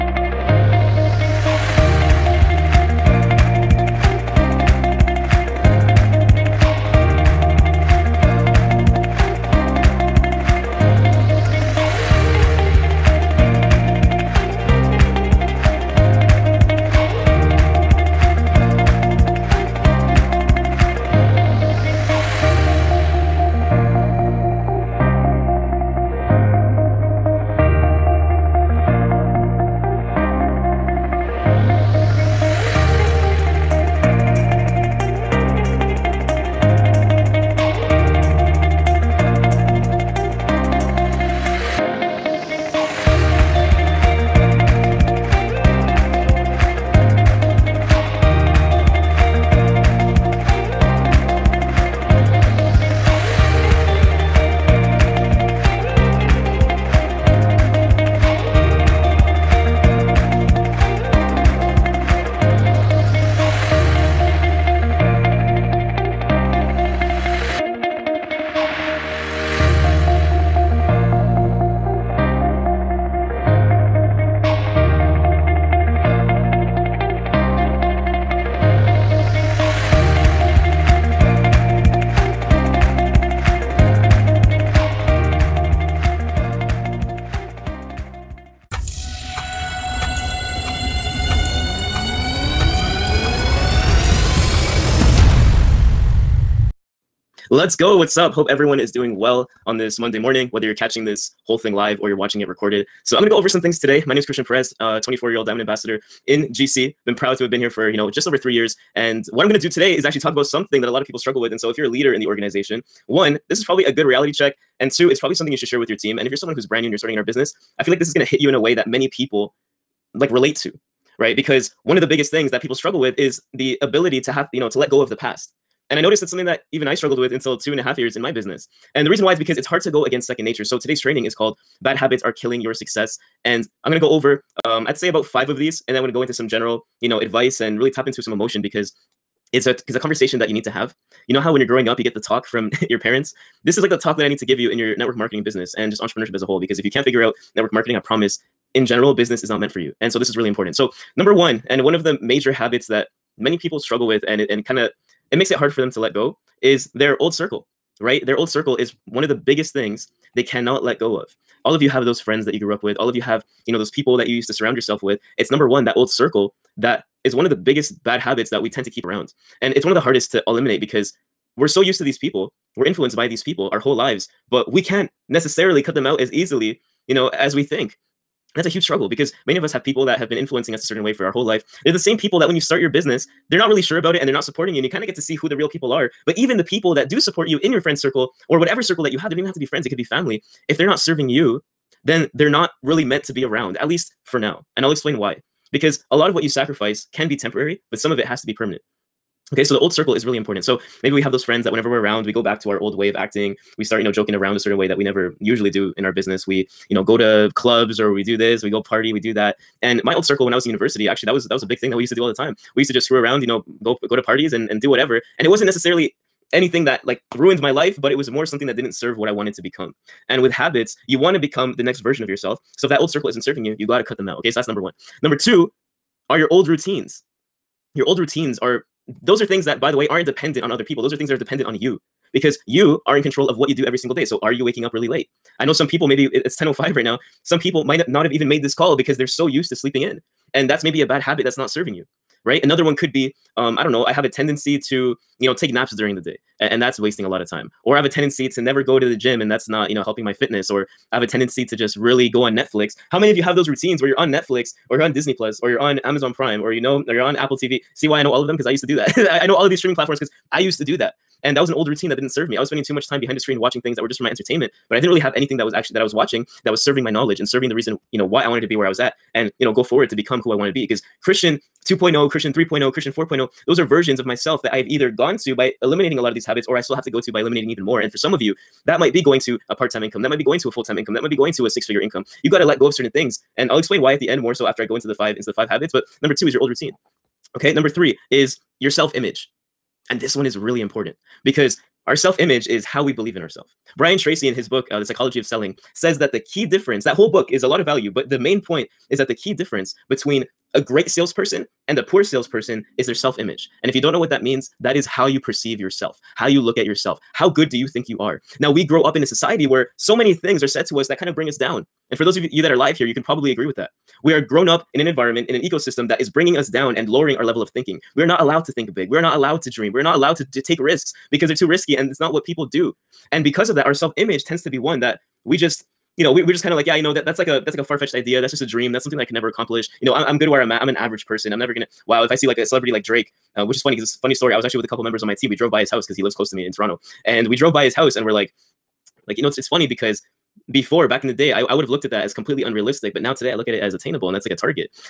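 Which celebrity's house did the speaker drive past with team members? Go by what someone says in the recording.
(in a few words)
Drake.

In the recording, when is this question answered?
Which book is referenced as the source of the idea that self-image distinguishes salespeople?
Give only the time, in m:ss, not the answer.
4:54.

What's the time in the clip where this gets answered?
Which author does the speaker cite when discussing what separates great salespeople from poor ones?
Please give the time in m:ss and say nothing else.
4:53.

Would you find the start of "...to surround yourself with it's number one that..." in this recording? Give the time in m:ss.
2:44.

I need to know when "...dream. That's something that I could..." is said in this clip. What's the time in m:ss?
5:28.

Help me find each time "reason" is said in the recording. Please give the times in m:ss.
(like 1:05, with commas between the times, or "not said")
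2:09, 4:27.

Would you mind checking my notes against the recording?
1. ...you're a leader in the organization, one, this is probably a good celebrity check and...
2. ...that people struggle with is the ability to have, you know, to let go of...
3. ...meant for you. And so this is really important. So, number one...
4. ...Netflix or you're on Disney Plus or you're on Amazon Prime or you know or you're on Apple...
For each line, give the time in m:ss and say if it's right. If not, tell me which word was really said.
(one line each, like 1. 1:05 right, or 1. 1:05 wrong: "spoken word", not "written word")
1. 1:51 wrong: "reality", not "celebrity"
2. 2:02 right
3. 2:29 right
4. 4:14 right.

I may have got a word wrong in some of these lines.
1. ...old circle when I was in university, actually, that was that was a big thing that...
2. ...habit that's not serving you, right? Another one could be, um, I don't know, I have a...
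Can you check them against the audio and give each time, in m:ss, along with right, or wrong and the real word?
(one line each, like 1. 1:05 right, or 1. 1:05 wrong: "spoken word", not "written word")
1. 3:30 right
2. 4:01 right.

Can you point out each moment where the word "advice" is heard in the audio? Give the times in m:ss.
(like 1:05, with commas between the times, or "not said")
2:17.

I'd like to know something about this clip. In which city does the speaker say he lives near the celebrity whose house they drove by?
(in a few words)
Toronto.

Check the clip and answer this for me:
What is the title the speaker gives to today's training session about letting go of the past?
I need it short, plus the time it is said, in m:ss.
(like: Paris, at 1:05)
Bad Habits Are Killing Your Success, at 2:11.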